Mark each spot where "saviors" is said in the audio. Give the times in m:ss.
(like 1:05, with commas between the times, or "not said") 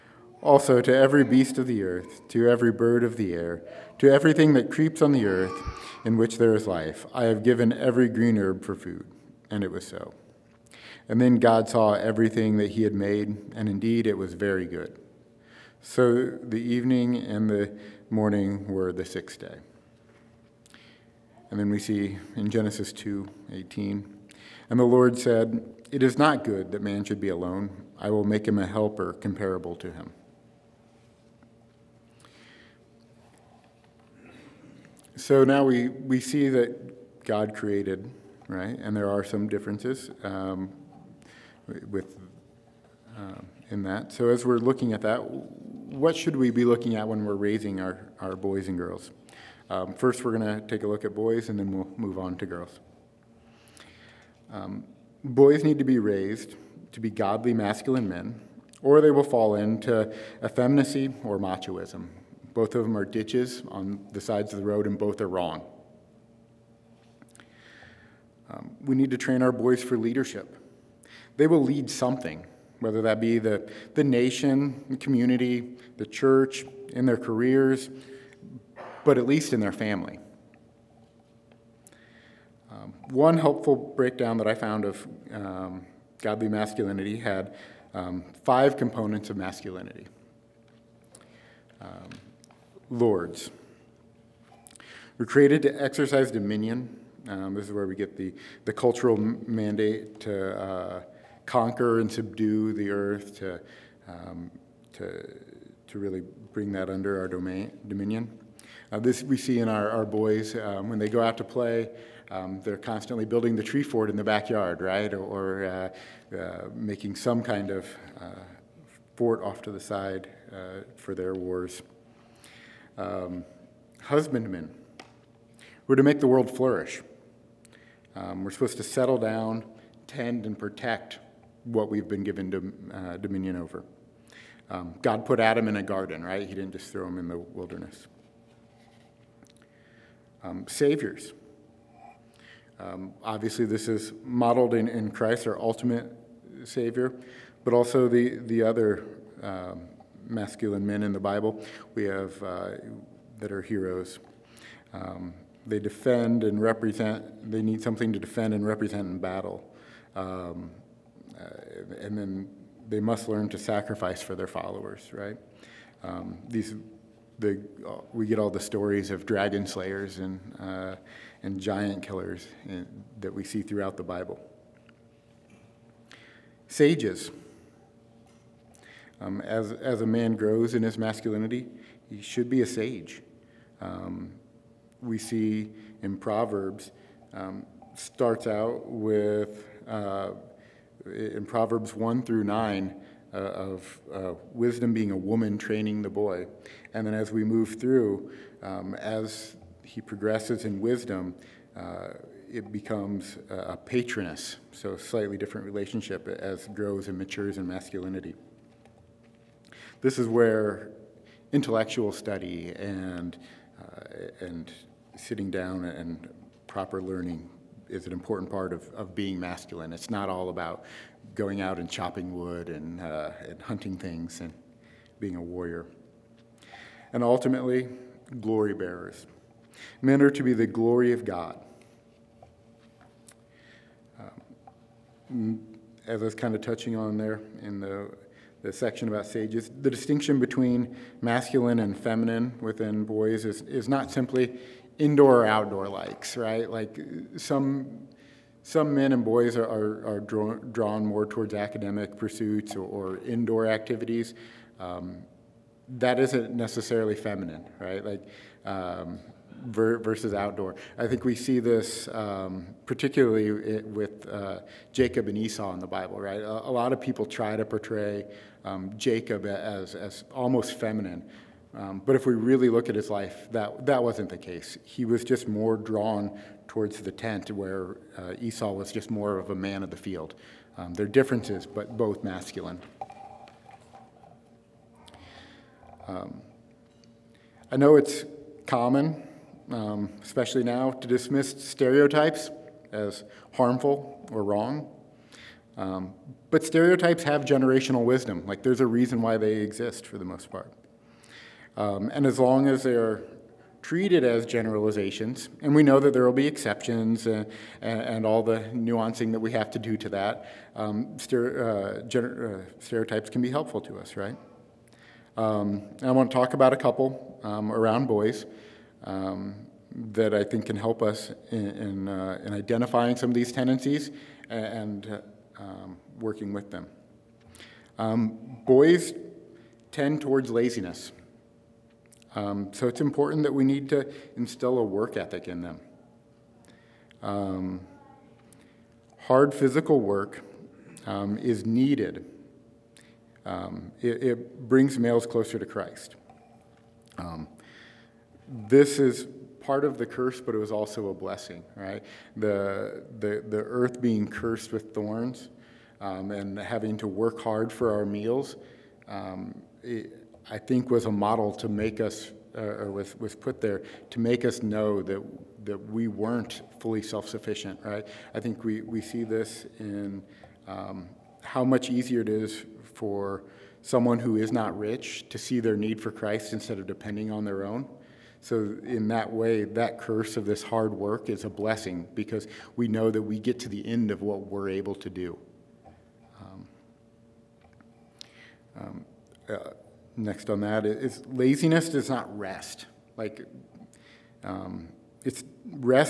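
2:20, 2:26.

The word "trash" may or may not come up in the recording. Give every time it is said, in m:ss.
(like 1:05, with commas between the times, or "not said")
not said.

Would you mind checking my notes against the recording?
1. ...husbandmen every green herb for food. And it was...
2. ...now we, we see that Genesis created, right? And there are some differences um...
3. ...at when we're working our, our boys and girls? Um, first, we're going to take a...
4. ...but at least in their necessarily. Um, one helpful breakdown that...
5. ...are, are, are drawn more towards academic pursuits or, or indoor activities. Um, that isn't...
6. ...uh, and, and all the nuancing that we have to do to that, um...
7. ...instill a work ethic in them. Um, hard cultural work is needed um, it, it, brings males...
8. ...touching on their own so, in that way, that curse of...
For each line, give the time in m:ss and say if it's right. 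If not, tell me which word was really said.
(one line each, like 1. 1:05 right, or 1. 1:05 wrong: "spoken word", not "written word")
1. 0:07 wrong: "given", not "husbandmen"
2. 0:35 wrong: "God", not "Genesis"
3. 0:46 wrong: "raising", not "working"
4. 1:19 wrong: "family", not "necessarily"
5. 4:09 right
6. 5:07 right
7. 5:34 wrong: "physical", not "cultural"
8. 6:16 wrong: "depending", not "touching".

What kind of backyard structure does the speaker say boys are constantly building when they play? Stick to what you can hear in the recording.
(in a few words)
Tree fort.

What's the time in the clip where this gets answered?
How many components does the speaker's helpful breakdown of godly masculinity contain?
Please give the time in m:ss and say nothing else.
1:28.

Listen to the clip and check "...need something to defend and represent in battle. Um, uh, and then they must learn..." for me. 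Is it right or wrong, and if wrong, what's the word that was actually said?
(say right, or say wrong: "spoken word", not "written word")
right.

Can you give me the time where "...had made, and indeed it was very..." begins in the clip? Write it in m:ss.
0:12.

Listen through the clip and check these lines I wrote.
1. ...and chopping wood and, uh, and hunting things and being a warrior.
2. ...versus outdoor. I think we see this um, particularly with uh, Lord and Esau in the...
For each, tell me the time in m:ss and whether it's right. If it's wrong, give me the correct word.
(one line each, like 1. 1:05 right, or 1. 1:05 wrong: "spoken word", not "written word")
1. 3:41 right
2. 4:19 wrong: "Jacob", not "Lord".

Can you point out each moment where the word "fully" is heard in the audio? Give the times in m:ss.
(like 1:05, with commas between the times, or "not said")
6:06.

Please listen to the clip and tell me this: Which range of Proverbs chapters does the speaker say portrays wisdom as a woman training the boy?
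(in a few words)
Chapters 1 through 9.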